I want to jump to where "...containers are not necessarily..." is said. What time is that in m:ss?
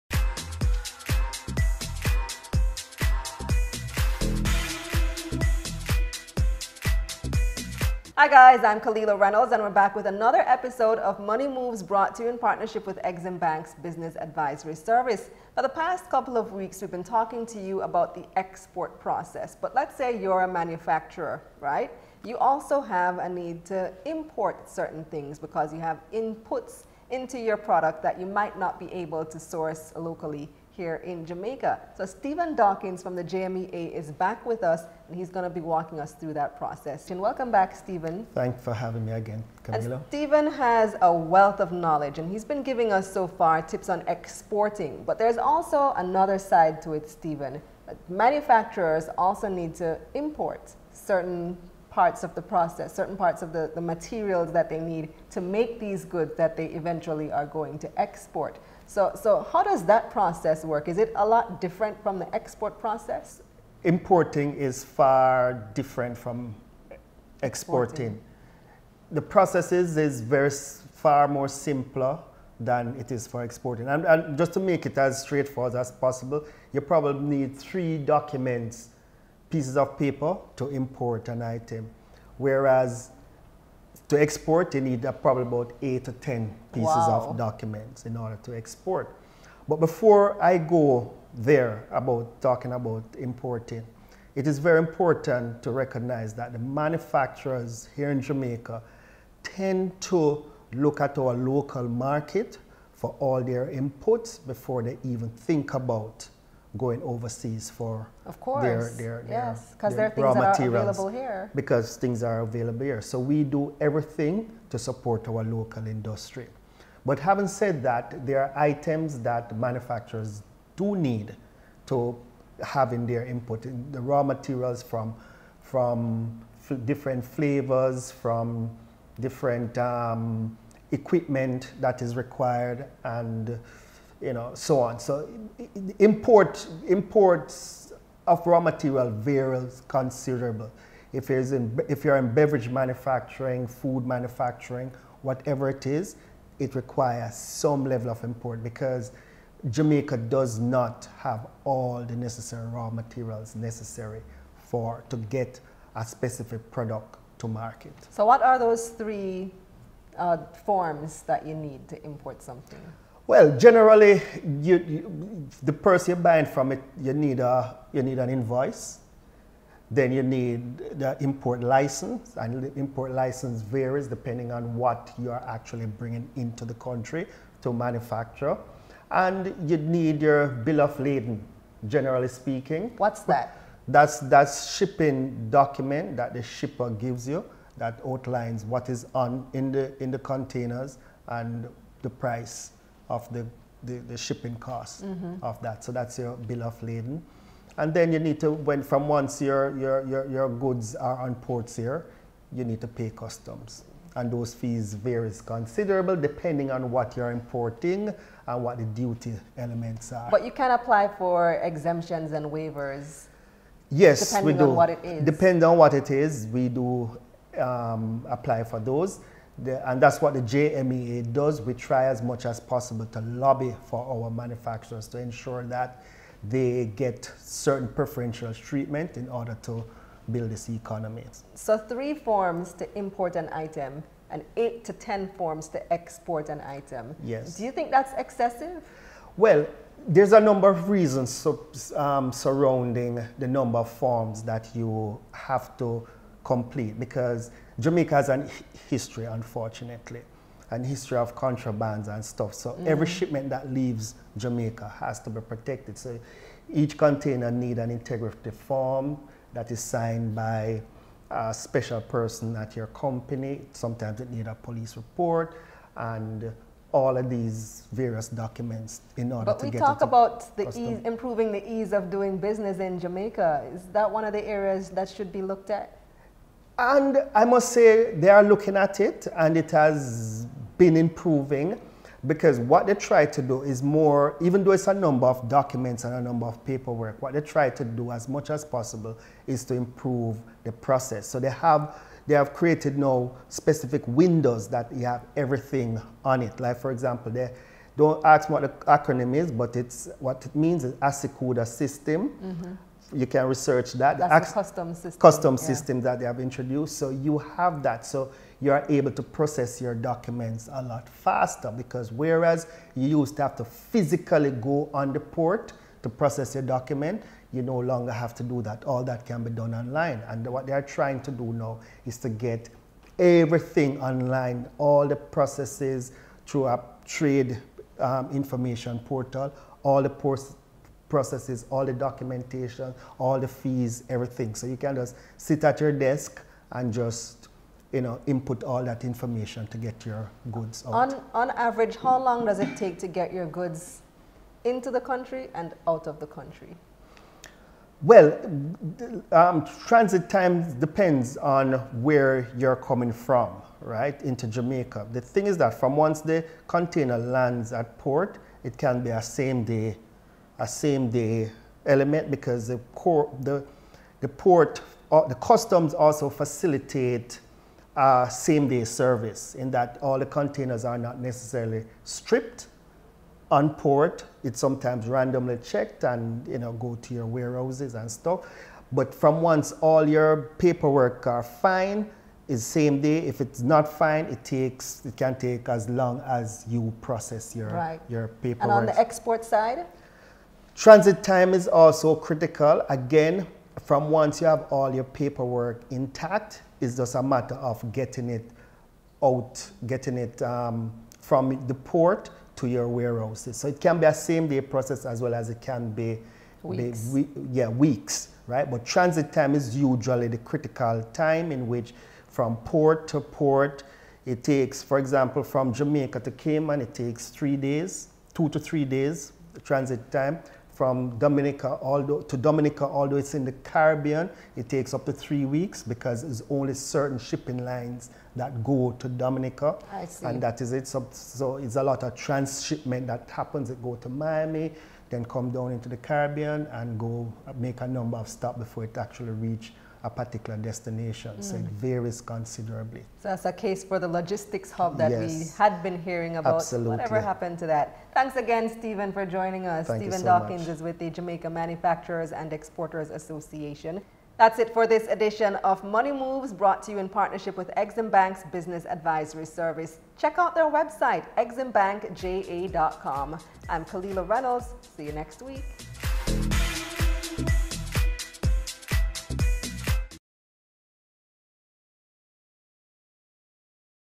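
6:10.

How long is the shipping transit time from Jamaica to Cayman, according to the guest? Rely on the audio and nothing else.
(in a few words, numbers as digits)
2 to 3 days.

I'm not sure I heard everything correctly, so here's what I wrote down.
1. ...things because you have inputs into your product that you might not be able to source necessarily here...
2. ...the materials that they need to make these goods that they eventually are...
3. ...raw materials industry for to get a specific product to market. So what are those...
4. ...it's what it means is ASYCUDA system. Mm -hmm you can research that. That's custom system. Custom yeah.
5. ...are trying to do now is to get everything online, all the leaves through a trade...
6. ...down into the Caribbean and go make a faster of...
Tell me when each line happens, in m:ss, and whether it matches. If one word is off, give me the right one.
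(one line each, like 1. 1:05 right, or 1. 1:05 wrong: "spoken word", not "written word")
1. 0:25 wrong: "locally", not "necessarily"
2. 0:53 right
3. 2:32 wrong: "necessary", not "industry"
4. 4:59 right
5. 5:20 wrong: "processes", not "leaves"
6. 7:15 wrong: "number", not "faster".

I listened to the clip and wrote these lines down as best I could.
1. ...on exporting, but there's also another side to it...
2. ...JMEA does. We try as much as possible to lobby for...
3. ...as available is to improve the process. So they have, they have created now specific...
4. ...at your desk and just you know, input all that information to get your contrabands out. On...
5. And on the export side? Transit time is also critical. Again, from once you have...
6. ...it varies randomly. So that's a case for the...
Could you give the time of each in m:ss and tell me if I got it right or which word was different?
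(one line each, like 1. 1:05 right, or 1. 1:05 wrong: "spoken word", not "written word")
1. 0:43 right
2. 3:40 right
3. 4:48 wrong: "possible", not "available"
4. 5:35 wrong: "goods", not "contrabands"
5. 6:28 right
6. 7:21 wrong: "considerably", not "randomly".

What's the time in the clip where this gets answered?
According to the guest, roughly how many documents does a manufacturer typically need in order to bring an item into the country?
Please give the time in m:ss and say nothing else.
1:17.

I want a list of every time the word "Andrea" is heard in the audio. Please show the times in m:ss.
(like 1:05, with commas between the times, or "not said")
not said.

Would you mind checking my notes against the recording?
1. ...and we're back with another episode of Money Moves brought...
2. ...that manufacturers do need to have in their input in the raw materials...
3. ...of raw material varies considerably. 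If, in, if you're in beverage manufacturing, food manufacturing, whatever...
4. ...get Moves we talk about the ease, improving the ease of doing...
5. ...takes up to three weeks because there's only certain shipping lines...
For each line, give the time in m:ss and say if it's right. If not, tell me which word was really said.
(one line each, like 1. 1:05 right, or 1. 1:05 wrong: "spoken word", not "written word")
1. 0:09 right
2. 1:59 right
3. 2:18 right
4. 4:29 wrong: "But", not "Moves"
5. 7:04 right.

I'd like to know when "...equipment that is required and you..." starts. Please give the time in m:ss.
2:10.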